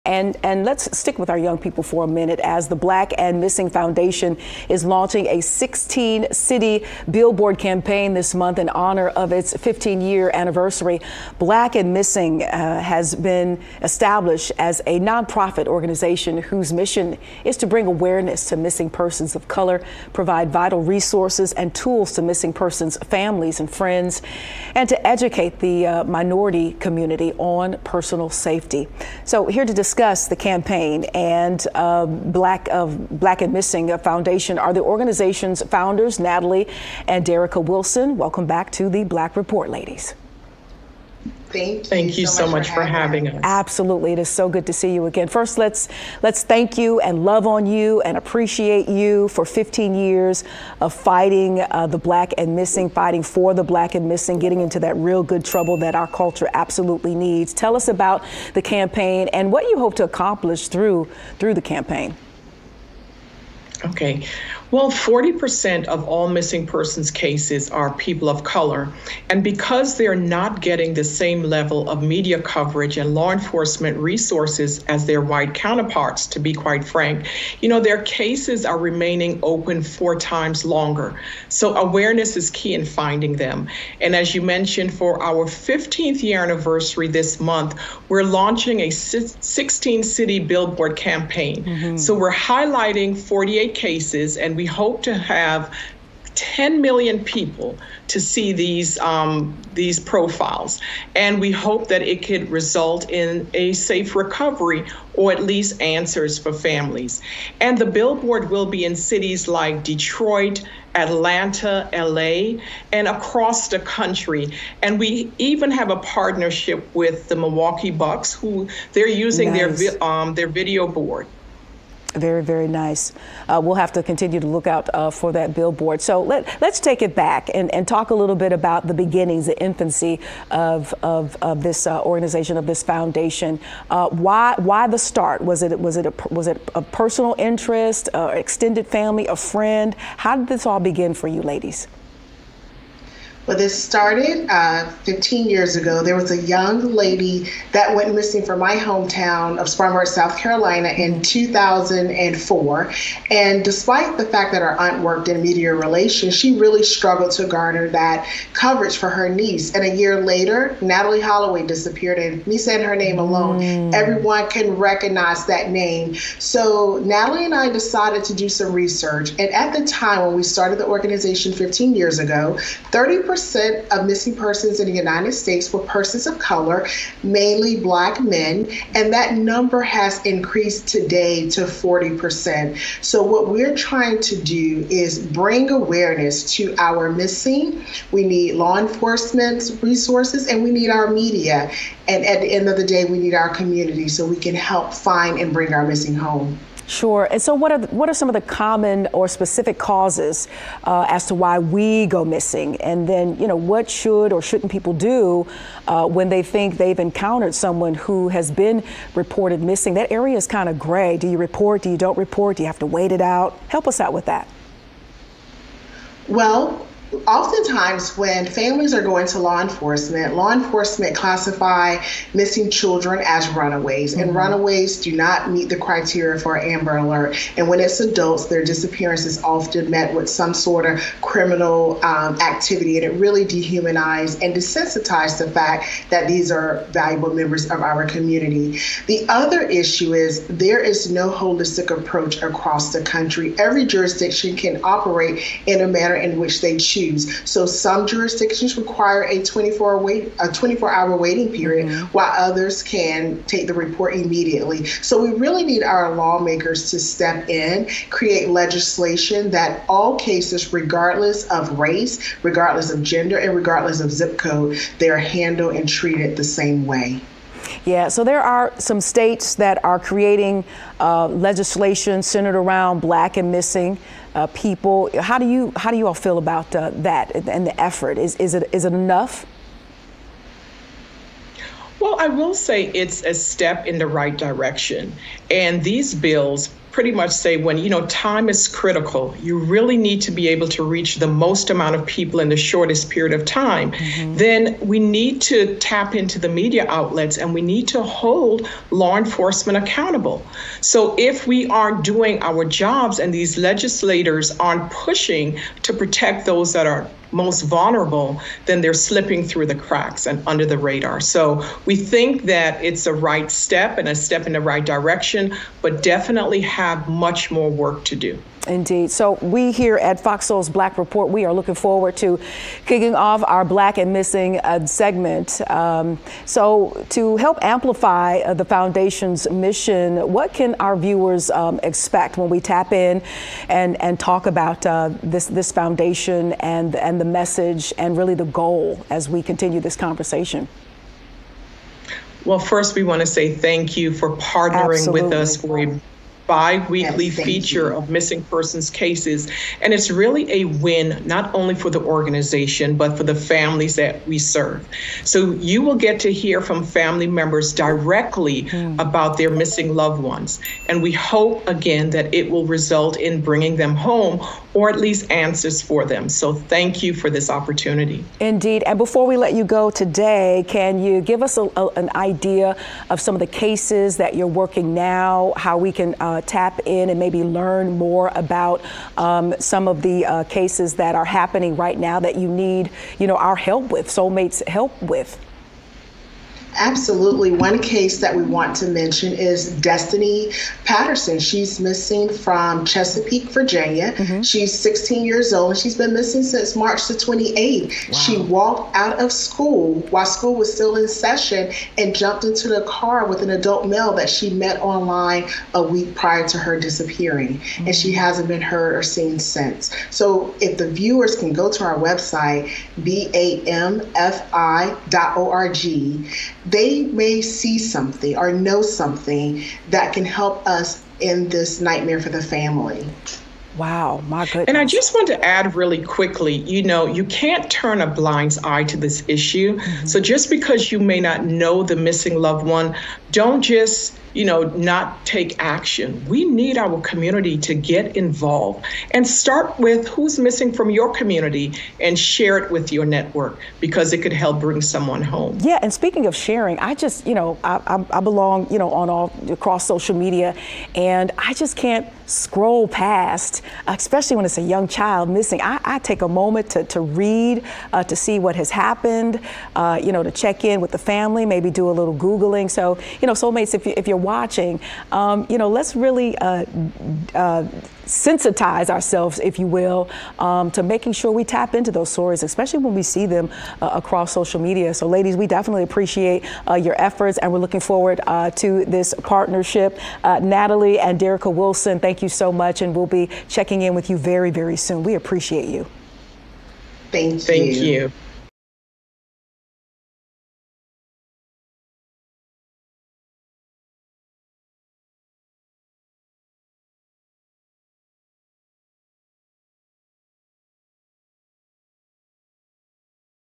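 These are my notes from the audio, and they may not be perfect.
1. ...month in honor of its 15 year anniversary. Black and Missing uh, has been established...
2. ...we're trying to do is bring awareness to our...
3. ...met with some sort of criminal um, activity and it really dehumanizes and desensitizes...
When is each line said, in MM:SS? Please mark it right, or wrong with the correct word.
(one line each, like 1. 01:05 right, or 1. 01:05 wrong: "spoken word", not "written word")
1. 00:08 right
2. 03:03 right
3. 03:49 right.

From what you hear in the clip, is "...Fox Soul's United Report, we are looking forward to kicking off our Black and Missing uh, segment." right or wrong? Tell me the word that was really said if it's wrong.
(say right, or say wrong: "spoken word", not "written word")
wrong: "Black", not "United".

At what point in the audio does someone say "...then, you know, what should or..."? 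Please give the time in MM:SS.
03:23.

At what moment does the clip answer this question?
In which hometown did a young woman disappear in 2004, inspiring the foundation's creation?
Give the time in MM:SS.
02:29.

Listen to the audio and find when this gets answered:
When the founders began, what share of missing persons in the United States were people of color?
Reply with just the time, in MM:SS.
02:52.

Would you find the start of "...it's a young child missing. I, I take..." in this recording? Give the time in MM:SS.
07:34.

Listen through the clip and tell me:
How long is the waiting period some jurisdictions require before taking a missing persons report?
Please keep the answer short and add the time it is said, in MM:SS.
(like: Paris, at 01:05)
24 hours, at 04:10.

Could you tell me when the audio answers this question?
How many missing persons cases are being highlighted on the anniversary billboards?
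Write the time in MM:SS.
01:33.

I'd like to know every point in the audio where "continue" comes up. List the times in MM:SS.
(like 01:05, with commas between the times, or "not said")
02:04, 05:39.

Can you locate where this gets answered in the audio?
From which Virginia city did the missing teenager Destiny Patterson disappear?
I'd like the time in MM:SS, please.
06:32.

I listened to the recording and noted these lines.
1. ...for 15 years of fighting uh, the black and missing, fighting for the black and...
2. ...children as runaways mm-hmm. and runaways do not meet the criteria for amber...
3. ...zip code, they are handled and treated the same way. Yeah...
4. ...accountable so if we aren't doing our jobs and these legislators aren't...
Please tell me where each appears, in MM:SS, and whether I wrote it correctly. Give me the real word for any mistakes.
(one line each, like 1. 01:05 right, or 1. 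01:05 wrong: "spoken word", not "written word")
1. 00:49 right
2. 03:42 right
3. 04:24 right
4. 04:59 right.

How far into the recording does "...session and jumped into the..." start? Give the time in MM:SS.
06:41.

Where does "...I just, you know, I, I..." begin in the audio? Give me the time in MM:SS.
07:26.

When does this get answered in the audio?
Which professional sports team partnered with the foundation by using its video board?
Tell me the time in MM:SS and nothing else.
01:57.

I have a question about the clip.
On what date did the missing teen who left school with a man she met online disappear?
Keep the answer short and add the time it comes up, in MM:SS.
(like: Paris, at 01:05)
March 28, at 06:36.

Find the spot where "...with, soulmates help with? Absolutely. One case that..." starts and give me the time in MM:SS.
06:23.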